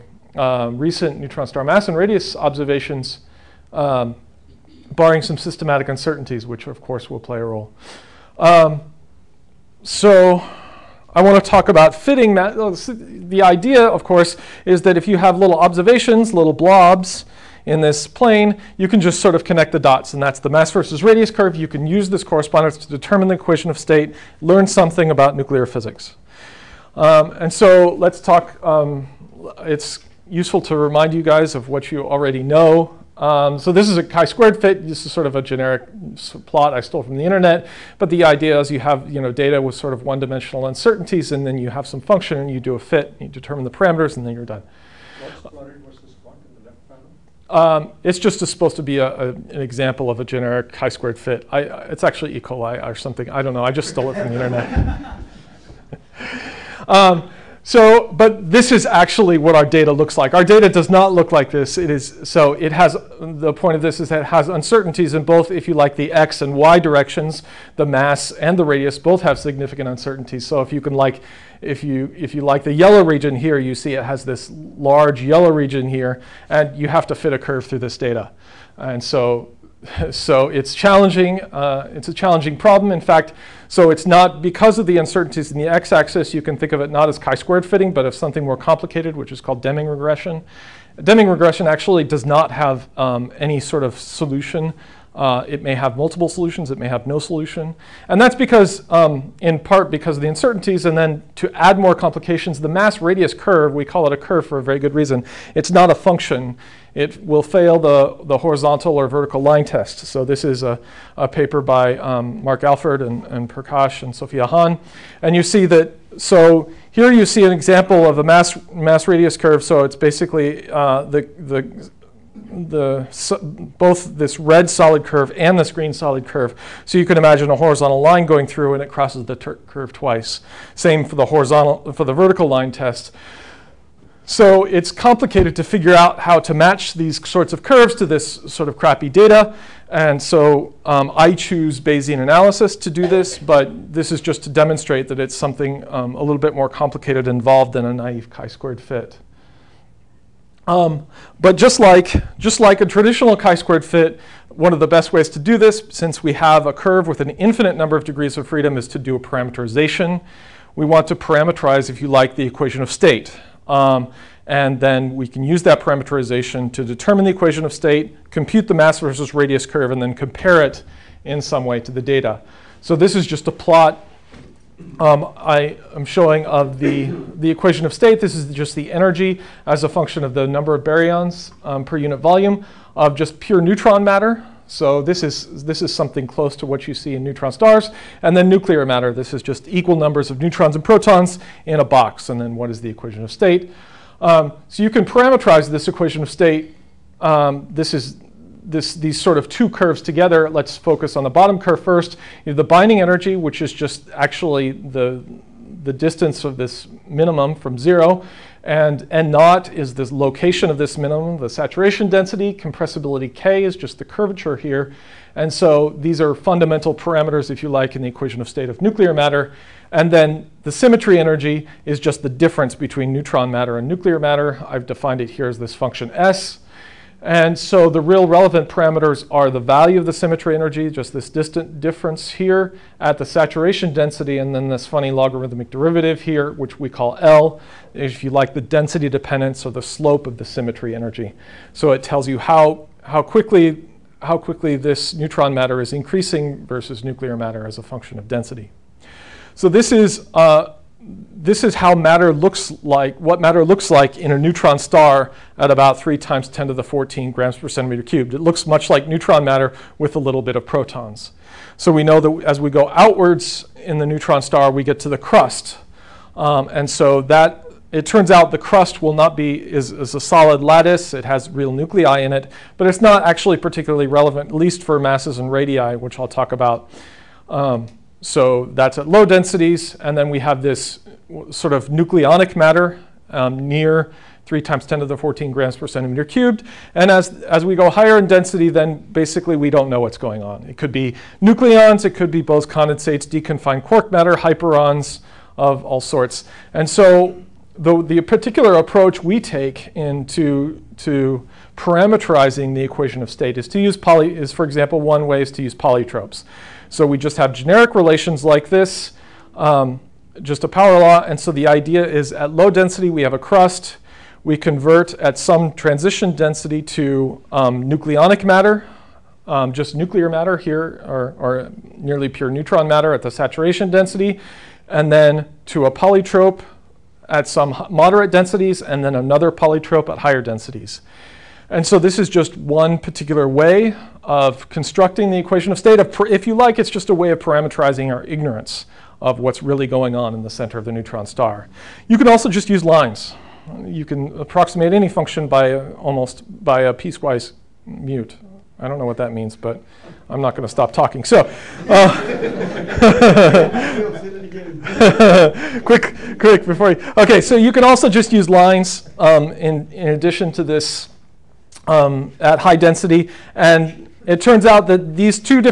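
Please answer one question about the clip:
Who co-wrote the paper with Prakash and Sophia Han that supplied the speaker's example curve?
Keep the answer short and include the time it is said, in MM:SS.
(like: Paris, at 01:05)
Mark Alford, at 01:52.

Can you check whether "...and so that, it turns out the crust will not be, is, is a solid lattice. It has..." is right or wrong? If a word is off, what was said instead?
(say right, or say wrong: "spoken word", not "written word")
right.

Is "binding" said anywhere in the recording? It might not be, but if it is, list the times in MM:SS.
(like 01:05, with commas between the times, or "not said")
03:22.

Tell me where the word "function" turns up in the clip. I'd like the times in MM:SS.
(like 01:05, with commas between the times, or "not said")
00:41, 01:45, 02:59, 03:45, 04:07, 05:45.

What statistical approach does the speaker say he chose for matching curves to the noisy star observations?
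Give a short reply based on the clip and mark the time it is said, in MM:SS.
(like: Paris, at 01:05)
Bayesian analysis, at 02:21.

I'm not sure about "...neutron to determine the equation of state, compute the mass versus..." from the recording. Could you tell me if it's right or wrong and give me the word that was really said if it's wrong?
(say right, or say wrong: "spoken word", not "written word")
wrong: "parameterization", not "neutron".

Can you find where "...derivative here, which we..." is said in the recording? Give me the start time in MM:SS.
03:55.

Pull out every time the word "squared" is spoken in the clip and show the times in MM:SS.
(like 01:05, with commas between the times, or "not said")
00:34, 00:50, 01:27, 02:28, 02:33.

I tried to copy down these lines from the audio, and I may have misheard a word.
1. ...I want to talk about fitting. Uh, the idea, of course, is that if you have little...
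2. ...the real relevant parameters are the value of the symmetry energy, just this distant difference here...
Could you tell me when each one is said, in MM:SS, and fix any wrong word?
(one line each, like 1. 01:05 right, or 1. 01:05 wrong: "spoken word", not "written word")
1. 00:11 right
2. 03:47 right.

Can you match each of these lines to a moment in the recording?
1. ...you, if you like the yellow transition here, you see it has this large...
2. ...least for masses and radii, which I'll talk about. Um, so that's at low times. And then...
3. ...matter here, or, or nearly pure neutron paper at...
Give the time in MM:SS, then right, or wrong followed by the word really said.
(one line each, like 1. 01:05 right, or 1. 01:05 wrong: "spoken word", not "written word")
1. 01:11 wrong: "region", not "transition"
2. 04:34 wrong: "densities", not "times"
3. 05:20 wrong: "matter", not "paper".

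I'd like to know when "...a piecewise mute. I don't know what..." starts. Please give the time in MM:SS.
05:46.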